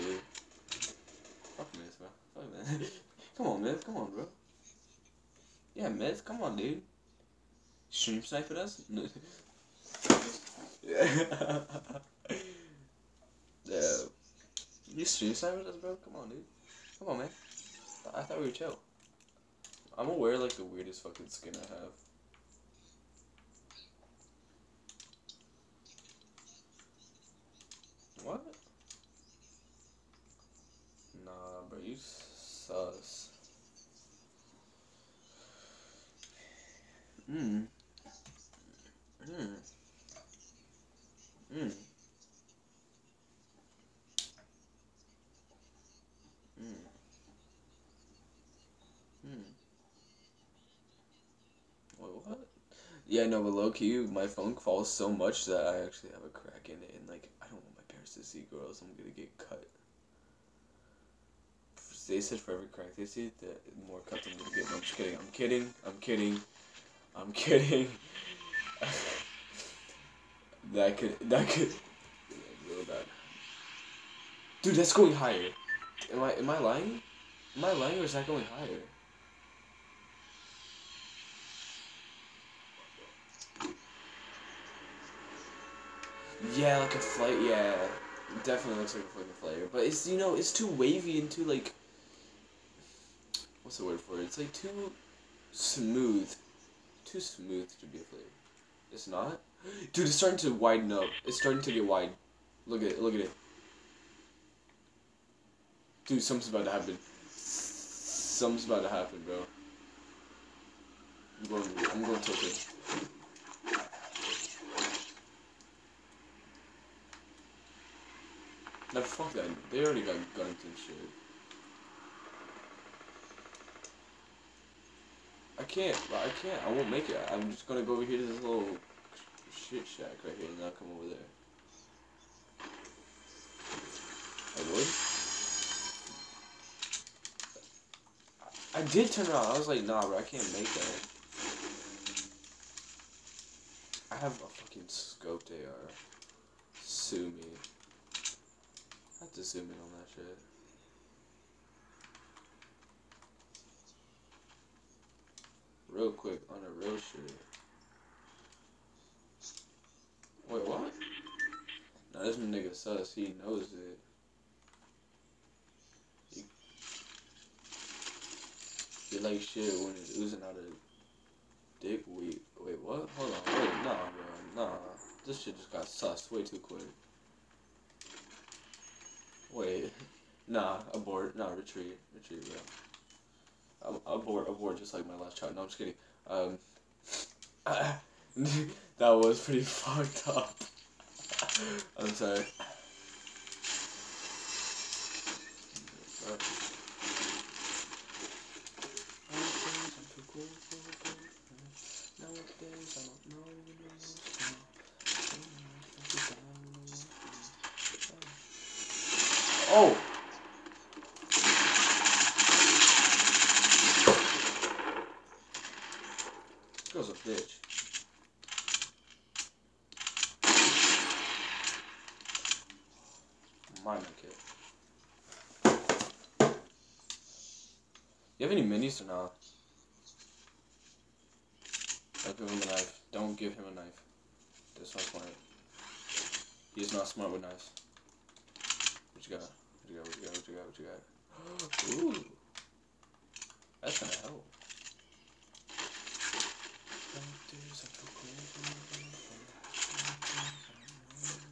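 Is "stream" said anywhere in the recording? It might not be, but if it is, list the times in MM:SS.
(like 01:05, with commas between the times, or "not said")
00:07, 00:15.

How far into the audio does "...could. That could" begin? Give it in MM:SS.
01:10.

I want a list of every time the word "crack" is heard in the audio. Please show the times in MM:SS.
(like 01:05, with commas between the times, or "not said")
00:56, 01:02.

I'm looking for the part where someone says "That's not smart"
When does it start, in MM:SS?
03:54.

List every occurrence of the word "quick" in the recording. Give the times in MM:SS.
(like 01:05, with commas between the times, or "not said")
02:36, 02:56.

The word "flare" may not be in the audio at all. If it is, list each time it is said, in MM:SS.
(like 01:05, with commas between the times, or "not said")
01:38.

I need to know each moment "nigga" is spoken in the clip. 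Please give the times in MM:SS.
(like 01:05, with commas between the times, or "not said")
02:42.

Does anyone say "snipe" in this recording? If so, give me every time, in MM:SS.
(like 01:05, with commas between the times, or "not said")
00:08, 00:15.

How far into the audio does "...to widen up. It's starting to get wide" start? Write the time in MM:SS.
01:40.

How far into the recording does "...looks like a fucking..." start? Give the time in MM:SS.
01:28.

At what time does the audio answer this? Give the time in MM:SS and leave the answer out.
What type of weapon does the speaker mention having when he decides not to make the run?
02:24.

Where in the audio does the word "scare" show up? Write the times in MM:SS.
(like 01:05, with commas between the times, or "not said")
not said.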